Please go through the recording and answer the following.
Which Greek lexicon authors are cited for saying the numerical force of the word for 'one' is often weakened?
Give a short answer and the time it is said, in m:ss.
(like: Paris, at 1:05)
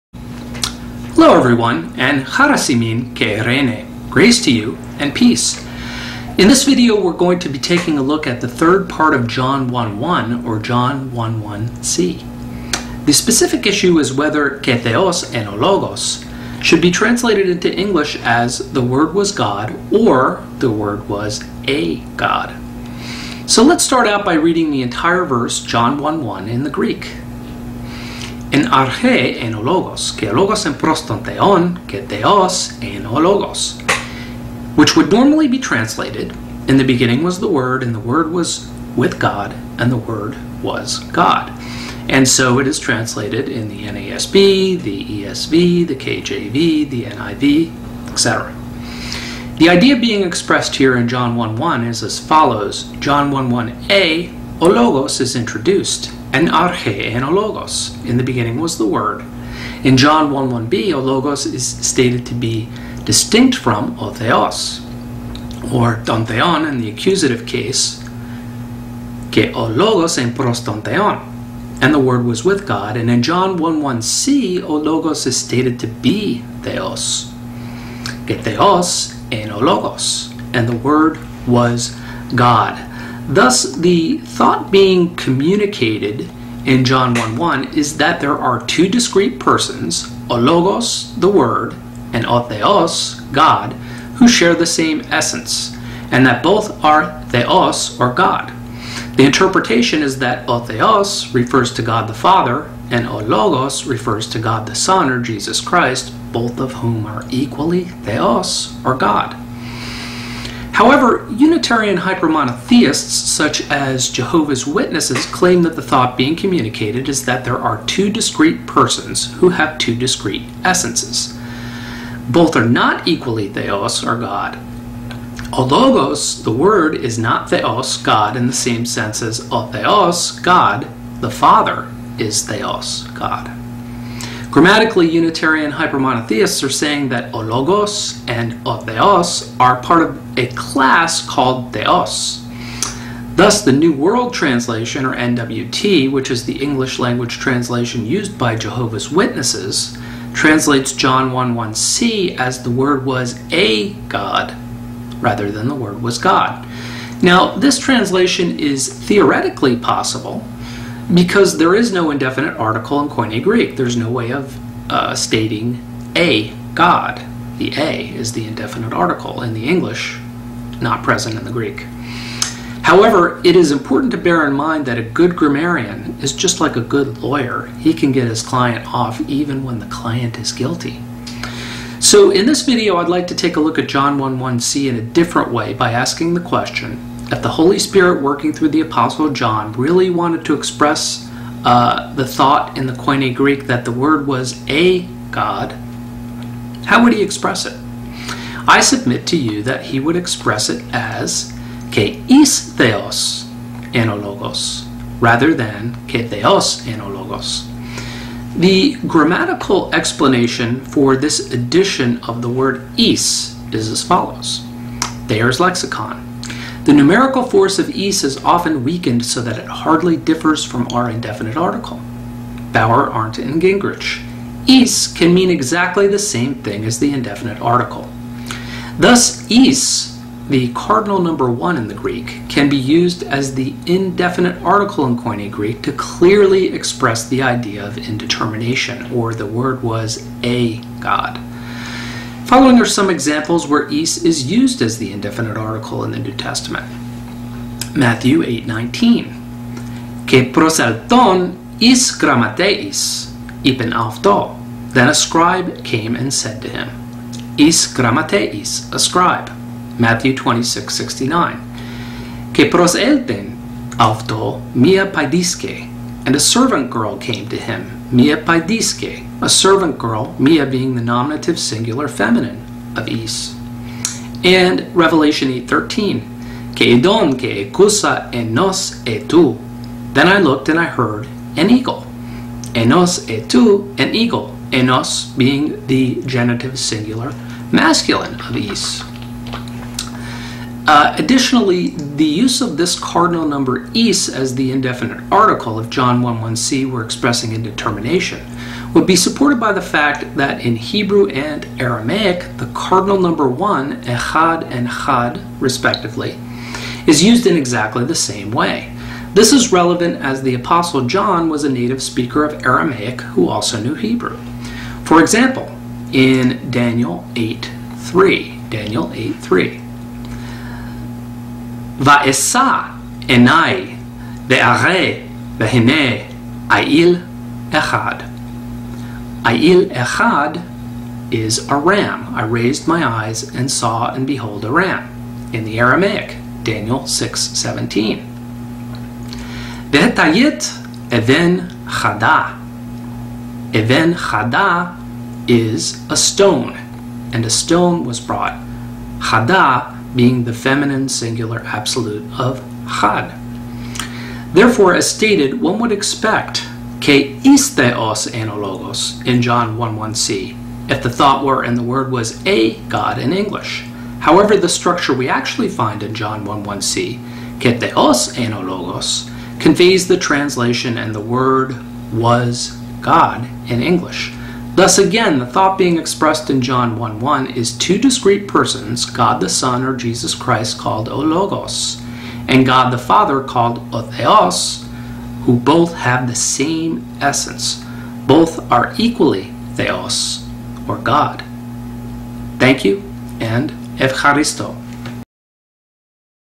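Bauer, Arndt, and Gingrich, at 3:42.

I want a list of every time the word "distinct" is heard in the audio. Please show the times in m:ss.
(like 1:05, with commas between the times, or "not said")
1:03.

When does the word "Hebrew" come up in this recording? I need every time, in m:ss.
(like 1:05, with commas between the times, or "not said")
5:00, 5:13.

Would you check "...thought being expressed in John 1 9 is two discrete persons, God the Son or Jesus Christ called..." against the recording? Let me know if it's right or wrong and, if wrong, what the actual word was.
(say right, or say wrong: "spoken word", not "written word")
wrong: "1", not "9".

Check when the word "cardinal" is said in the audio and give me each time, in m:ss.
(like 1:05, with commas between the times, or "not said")
3:50, 4:52, 5:02.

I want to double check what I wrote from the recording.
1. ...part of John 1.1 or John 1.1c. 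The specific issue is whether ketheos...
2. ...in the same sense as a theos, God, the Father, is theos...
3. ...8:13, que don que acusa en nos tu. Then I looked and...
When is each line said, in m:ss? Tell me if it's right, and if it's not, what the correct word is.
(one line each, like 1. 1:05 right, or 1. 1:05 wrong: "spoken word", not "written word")
1. 0:08 right
2. 2:08 right
3. 4:35 right.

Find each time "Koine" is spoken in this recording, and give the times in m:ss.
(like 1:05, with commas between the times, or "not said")
2:43, 3:12, 3:55.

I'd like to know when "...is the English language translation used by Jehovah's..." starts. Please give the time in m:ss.
2:26.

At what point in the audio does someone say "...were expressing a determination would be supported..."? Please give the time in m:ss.
4:56.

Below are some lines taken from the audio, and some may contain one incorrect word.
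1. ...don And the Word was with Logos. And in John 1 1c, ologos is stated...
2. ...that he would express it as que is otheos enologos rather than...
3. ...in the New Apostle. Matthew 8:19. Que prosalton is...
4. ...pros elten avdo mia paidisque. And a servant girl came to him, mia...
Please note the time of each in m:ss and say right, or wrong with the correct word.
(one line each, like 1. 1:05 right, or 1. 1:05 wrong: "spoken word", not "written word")
1. 1:10 wrong: "God", not "Logos"
2. 3:19 wrong: "theos", not "otheos"
3. 4:06 wrong: "Testament", not "Apostle"
4. 4:22 right.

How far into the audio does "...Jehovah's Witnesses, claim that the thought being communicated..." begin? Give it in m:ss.
1:54.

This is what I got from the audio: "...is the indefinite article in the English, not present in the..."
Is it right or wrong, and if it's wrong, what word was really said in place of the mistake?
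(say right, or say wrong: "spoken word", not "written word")
right.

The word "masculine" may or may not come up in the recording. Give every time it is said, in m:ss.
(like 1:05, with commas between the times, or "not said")
4:47.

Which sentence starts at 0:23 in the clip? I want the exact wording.
So let's start out by reading the entire verse, John 1.1, in the Greek.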